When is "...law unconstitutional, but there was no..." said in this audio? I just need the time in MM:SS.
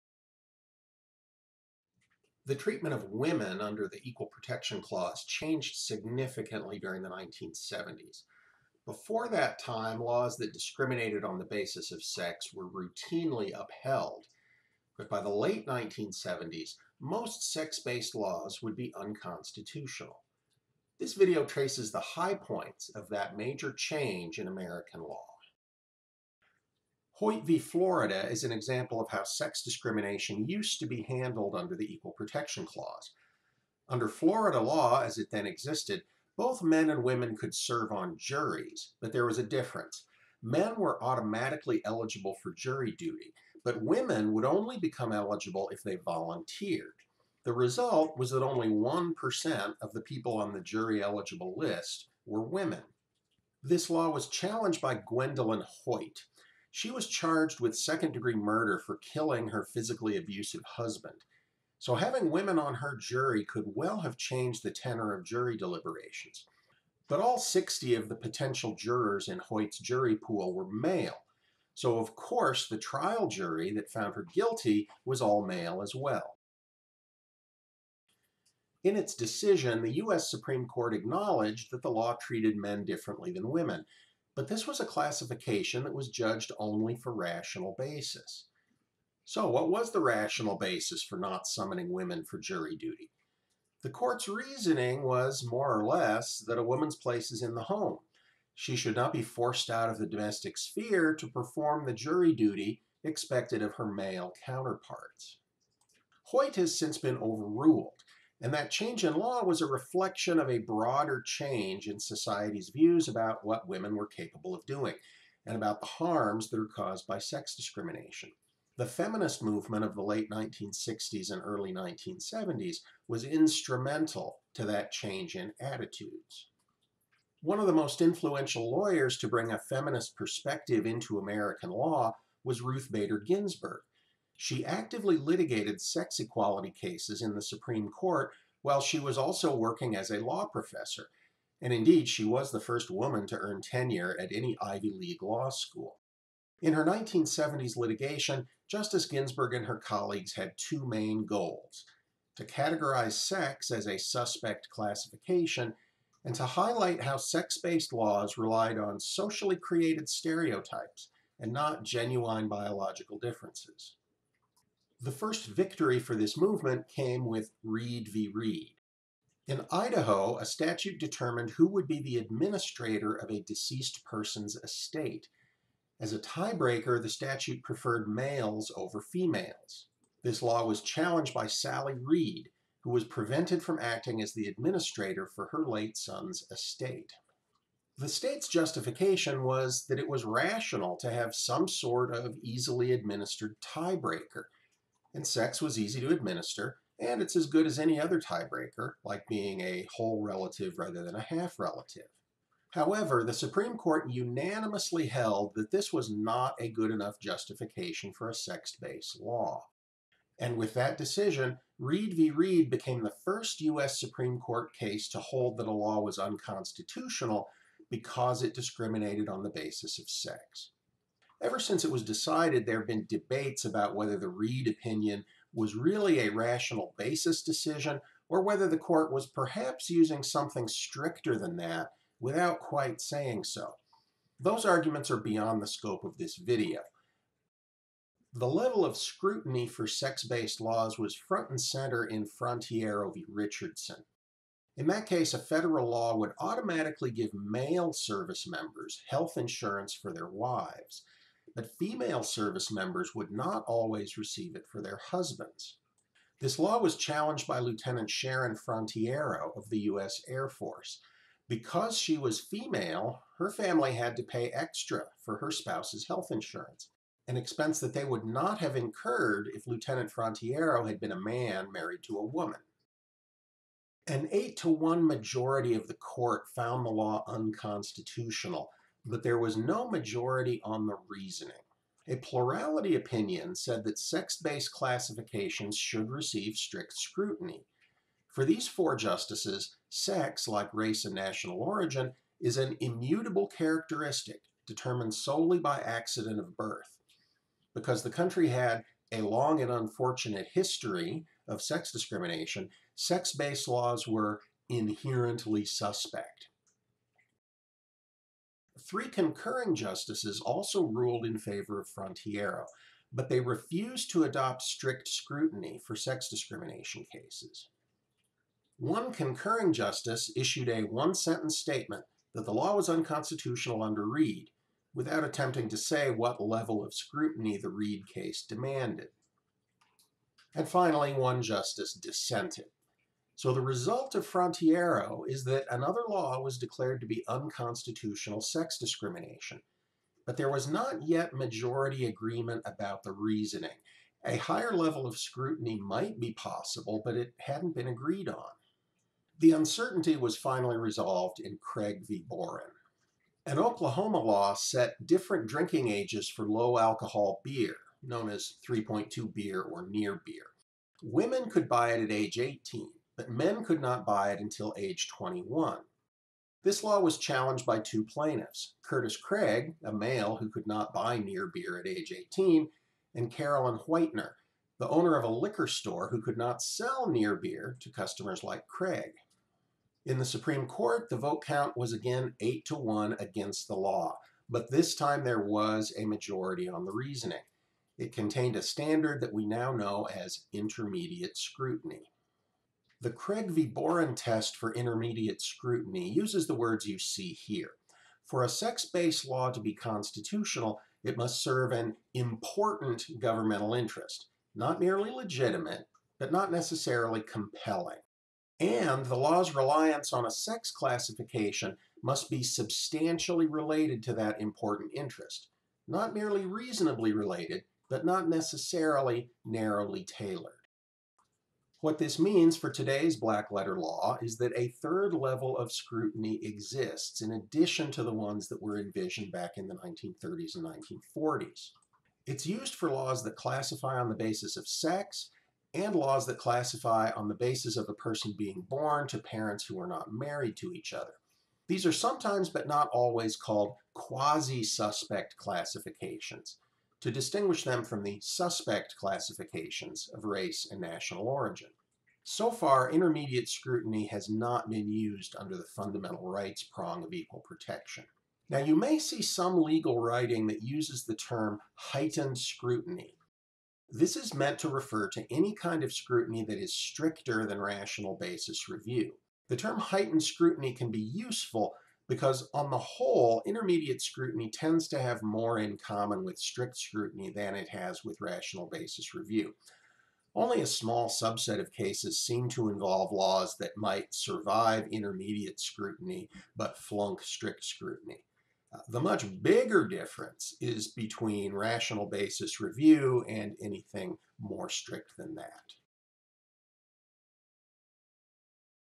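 04:36.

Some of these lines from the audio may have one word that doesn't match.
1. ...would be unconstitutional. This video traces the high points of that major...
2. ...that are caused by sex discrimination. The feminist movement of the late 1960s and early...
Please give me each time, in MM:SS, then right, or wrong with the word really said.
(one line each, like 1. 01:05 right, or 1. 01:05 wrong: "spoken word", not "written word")
1. 00:18 right
2. 01:56 right.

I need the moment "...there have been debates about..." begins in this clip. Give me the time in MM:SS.
03:42.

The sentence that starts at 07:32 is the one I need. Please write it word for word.
So far, intermediate scrutiny has not been used under the fundamental rights prong of equal protection.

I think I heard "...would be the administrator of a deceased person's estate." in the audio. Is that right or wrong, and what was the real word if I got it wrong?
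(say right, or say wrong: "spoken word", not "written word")
right.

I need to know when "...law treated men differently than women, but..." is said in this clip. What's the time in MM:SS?
01:21.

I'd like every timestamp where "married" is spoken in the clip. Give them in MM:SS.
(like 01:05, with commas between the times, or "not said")
04:31, 07:20.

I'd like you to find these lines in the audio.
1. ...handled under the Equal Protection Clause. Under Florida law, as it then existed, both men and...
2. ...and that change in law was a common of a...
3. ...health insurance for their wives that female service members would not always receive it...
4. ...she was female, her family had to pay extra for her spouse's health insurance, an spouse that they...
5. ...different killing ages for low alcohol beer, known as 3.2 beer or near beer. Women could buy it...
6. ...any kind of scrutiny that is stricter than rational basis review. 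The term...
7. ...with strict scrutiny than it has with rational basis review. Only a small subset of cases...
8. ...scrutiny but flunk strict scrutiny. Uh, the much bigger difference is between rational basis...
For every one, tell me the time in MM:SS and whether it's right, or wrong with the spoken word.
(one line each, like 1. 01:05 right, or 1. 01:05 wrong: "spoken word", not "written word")
1. 00:31 right
2. 01:48 wrong: "reflection", not "common"
3. 04:09 right
4. 04:21 wrong: "expense", not "spouse"
5. 05:55 wrong: "drinking", not "killing"
6. 07:45 right
7. 07:56 right
8. 08:05 right.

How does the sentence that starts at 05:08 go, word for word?
Three concurring justices also ruled in favor of Frontiero, but they refused to adopt strict scrutiny for sex discrimination cases.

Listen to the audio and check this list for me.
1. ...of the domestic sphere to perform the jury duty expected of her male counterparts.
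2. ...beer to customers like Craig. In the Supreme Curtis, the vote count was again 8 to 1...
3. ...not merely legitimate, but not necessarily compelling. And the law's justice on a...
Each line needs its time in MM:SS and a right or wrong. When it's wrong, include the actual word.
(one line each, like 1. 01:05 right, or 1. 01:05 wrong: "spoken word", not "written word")
1. 01:39 right
2. 06:17 wrong: "Court", not "Curtis"
3. 06:44 wrong: "reliance", not "justice".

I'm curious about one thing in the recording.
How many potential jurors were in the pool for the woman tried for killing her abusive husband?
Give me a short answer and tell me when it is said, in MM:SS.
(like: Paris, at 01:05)
60, at 01:07.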